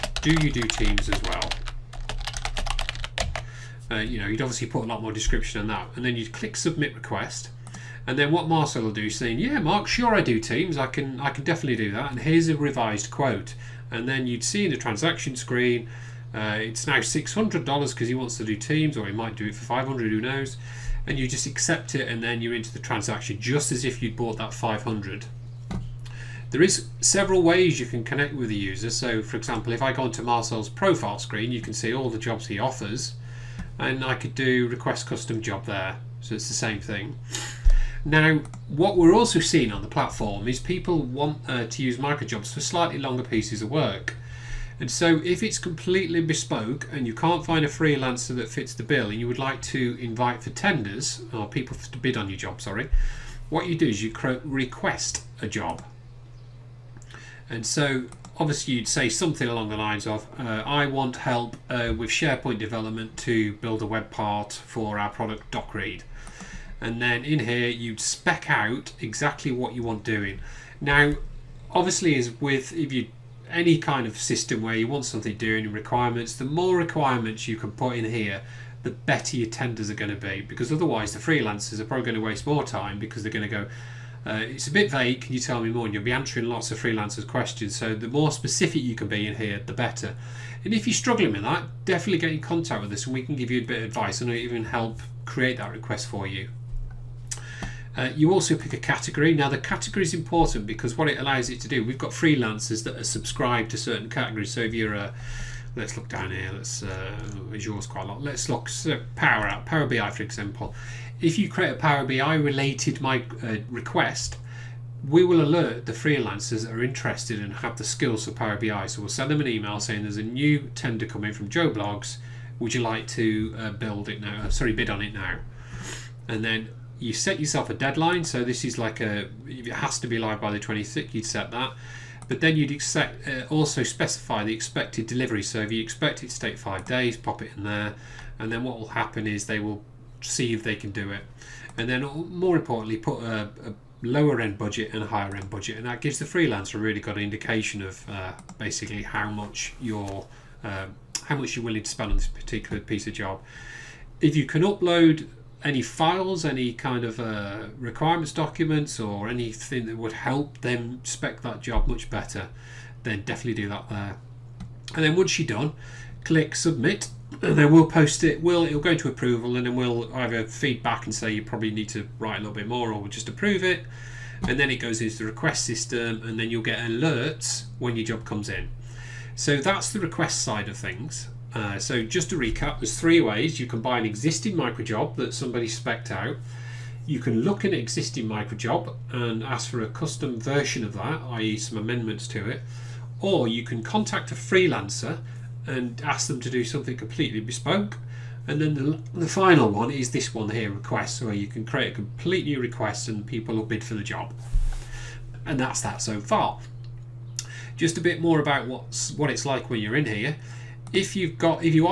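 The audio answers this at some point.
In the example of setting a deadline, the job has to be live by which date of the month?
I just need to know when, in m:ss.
2:10.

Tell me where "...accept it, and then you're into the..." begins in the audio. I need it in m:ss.
0:21.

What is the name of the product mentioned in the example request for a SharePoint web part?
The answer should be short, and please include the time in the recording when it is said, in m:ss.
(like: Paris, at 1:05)
DocRead, at 1:05.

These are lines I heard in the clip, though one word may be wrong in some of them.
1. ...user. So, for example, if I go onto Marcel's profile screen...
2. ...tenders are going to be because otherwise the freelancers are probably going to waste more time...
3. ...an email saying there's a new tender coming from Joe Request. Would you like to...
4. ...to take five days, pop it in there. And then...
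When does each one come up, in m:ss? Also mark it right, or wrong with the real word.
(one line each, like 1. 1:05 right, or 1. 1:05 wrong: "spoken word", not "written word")
1. 0:28 right
2. 1:19 right
3. 1:59 wrong: "Bloggs", not "Request"
4. 2:16 right.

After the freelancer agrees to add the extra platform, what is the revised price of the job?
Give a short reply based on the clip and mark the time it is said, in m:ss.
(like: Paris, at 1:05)
$600, at 0:17.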